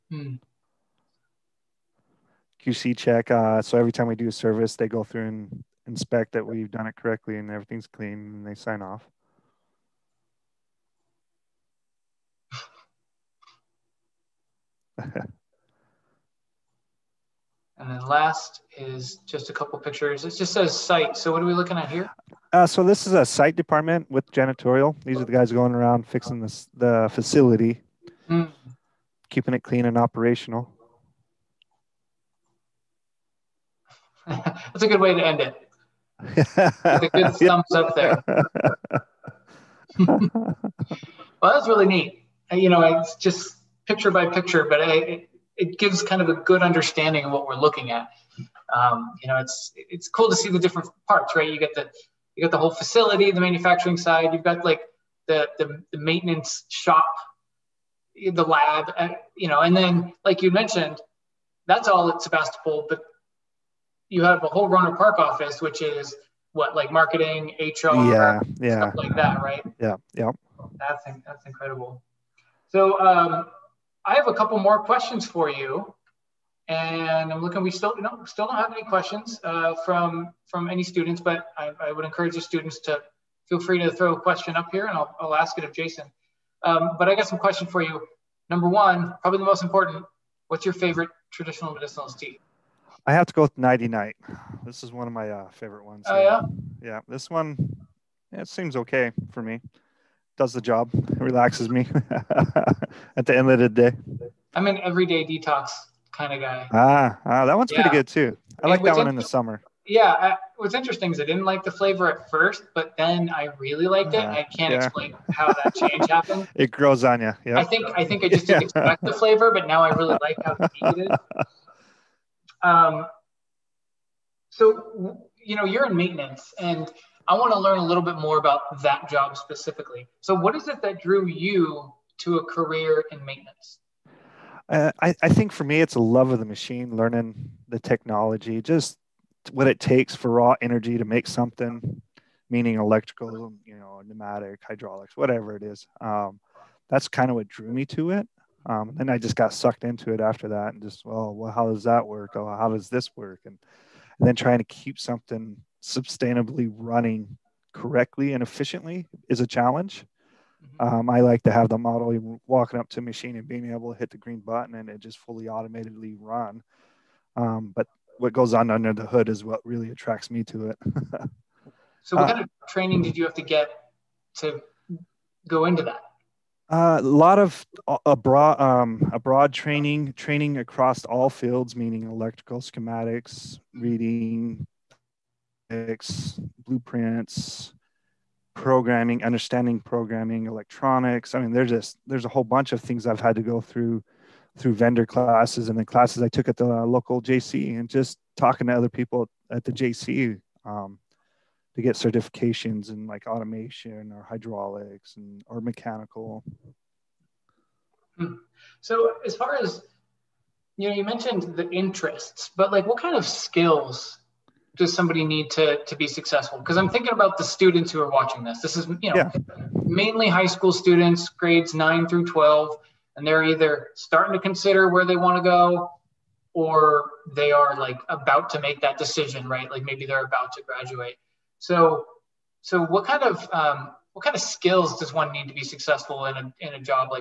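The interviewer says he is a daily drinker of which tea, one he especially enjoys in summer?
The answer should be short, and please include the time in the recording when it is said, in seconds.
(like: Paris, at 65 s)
Everyday Detox, at 104 s.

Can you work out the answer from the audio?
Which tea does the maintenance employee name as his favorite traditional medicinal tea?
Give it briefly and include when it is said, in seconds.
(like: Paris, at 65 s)
Nighty Night, at 93 s.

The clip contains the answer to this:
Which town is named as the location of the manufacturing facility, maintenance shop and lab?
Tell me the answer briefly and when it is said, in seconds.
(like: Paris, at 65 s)
Sebastopol, at 62 s.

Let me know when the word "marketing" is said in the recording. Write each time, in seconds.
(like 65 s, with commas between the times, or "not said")
66 s.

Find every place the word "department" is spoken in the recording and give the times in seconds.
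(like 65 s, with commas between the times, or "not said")
23 s.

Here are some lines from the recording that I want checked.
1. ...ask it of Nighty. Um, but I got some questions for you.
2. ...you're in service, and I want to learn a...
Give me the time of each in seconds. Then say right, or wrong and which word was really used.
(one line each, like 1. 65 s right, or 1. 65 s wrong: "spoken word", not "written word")
1. 85 s wrong: "Jason", not "Nighty"
2. 125 s wrong: "maintenance", not "service".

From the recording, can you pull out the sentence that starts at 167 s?
Um, but what goes on under the hood is what really attracts me to it.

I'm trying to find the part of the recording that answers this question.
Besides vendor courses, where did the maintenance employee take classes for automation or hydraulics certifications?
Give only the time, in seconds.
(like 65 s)
196 s.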